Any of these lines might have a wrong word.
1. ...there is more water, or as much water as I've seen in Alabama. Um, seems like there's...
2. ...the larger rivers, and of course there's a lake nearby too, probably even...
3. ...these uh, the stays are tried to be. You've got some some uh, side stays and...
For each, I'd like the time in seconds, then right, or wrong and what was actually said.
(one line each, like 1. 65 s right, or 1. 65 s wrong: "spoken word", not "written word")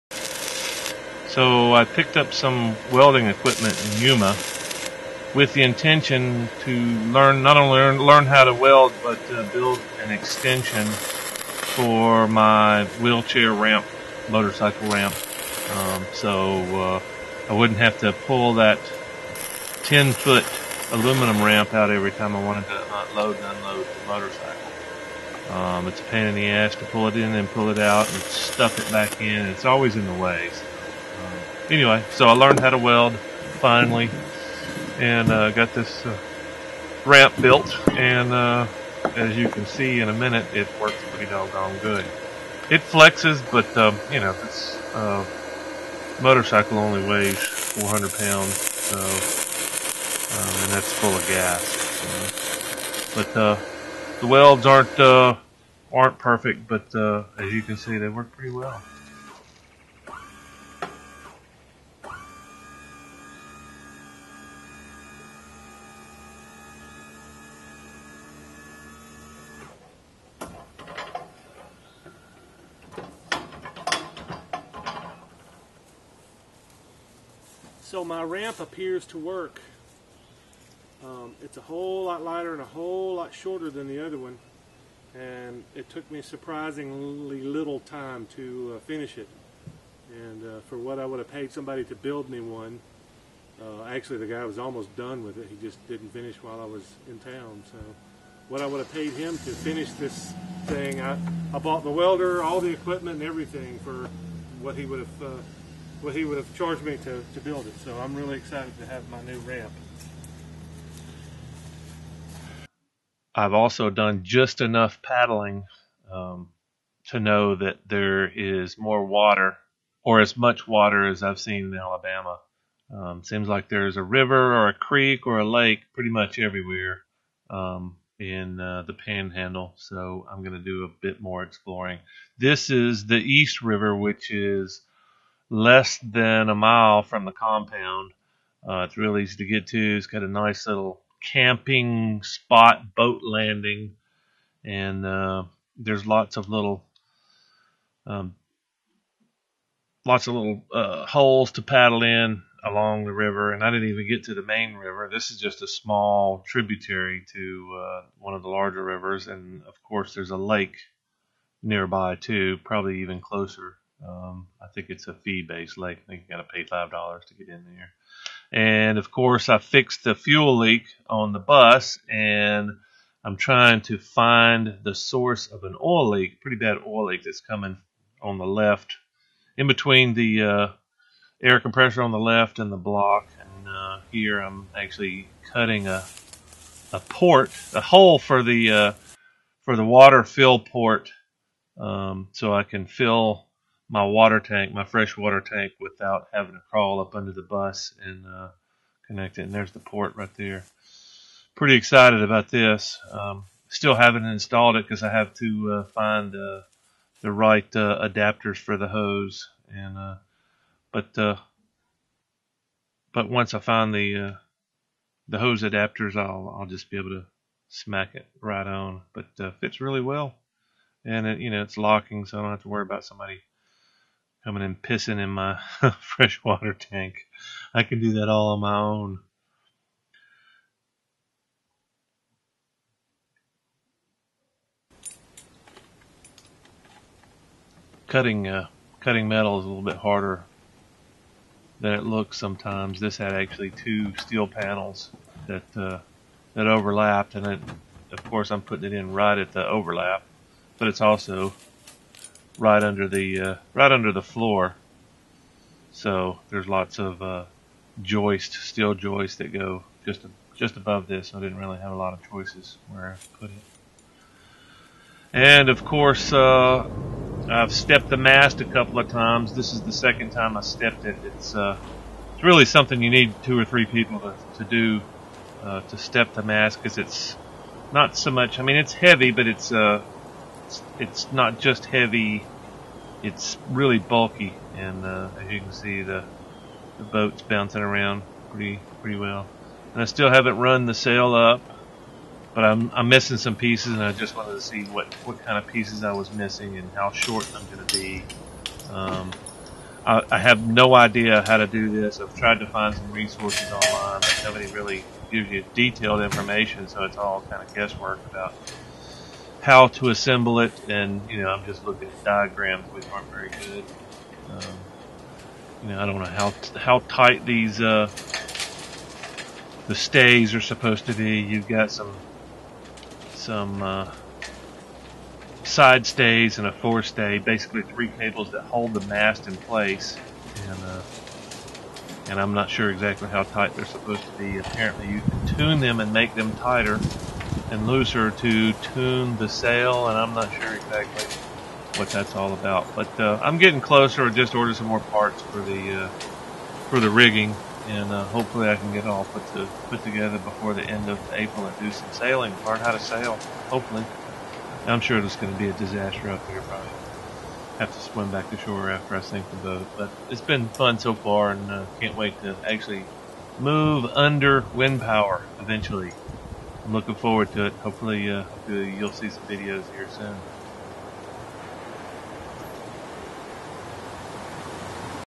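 1. 117 s right
2. 158 s right
3. 317 s wrong: "supposed", not "tried".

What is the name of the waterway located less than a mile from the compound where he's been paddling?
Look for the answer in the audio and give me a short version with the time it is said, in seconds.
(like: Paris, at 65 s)
East River, at 133 s.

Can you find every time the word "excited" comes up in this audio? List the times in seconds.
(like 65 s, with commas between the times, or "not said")
108 s, 201 s.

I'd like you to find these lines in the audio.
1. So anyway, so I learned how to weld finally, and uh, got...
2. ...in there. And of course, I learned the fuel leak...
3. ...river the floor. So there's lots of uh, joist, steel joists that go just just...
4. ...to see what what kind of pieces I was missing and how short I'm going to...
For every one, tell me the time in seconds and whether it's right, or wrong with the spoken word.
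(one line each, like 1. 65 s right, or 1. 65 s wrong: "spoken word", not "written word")
1. 30 s right
2. 167 s wrong: "fixed", not "learned"
3. 253 s wrong: "under", not "river"
4. 294 s right.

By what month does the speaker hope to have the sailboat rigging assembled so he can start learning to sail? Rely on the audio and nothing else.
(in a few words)
April.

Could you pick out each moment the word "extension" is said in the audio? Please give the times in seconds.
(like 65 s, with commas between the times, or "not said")
10 s.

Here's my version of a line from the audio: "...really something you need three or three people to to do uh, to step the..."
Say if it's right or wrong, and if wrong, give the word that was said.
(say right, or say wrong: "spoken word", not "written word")
wrong: "two", not "three".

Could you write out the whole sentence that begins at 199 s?
And there's the port right there.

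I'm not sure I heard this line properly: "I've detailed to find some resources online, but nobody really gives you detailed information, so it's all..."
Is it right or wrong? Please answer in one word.
wrong.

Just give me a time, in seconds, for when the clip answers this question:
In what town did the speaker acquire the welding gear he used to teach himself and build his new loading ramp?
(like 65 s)
4 s.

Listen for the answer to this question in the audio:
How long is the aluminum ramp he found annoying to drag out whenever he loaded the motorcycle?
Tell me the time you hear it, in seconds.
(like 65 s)
19 s.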